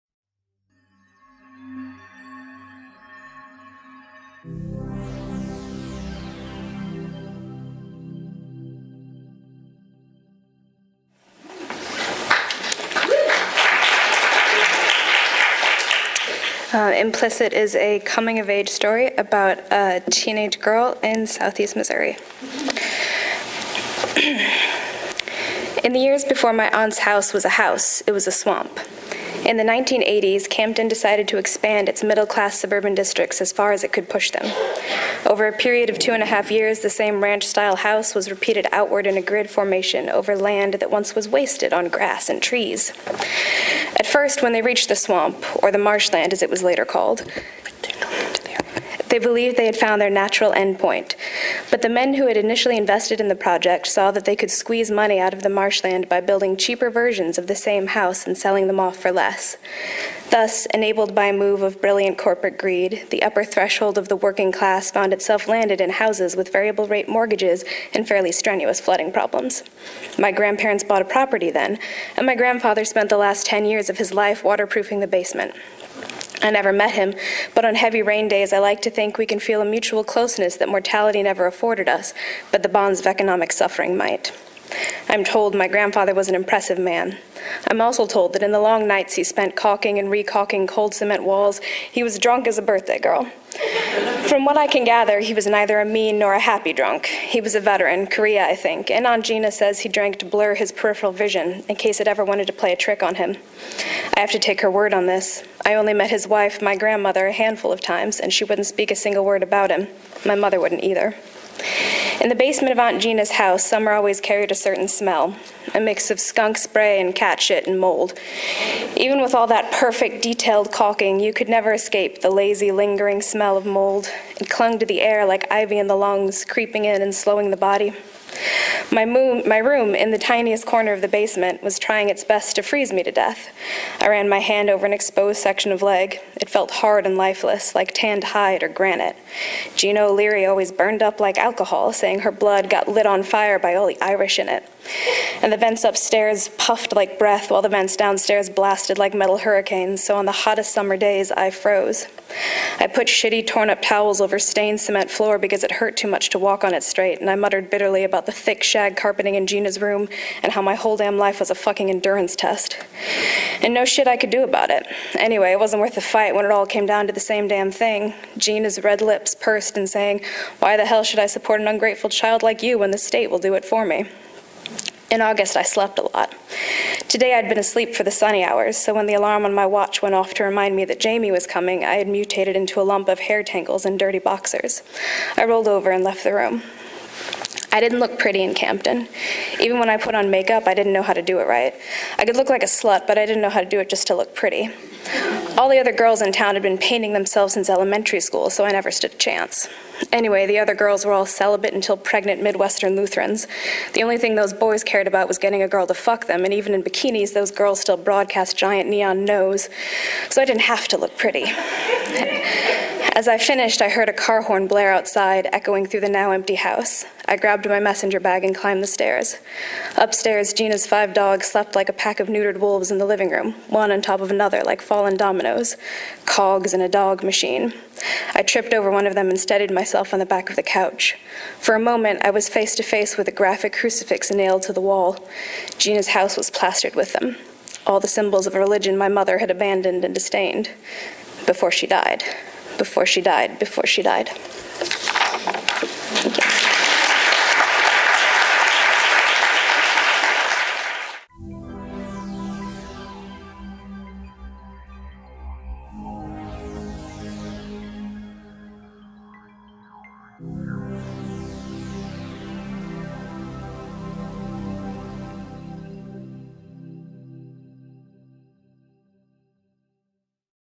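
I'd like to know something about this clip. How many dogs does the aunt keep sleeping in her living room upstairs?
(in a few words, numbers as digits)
5.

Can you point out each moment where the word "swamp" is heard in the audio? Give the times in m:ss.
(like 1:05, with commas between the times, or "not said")
0:28, 0:44.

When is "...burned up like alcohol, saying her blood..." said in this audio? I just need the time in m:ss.
2:20.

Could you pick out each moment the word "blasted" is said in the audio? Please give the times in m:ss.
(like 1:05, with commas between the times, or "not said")
2:28.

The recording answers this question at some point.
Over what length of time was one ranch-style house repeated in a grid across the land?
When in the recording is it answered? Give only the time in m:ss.
0:35.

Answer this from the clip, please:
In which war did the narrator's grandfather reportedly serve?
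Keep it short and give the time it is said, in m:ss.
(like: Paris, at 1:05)
Korea, at 1:38.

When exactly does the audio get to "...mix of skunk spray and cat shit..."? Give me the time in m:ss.
1:55.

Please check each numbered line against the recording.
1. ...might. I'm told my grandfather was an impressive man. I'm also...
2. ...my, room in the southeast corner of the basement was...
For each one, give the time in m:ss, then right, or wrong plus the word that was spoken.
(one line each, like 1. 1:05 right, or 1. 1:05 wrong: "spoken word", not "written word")
1. 1:23 right
2. 2:09 wrong: "tiniest", not "southeast".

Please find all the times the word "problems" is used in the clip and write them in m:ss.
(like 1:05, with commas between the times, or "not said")
1:09.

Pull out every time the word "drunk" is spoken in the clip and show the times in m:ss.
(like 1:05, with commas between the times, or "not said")
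1:32, 1:36.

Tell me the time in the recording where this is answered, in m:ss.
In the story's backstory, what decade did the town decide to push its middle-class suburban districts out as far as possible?
0:29.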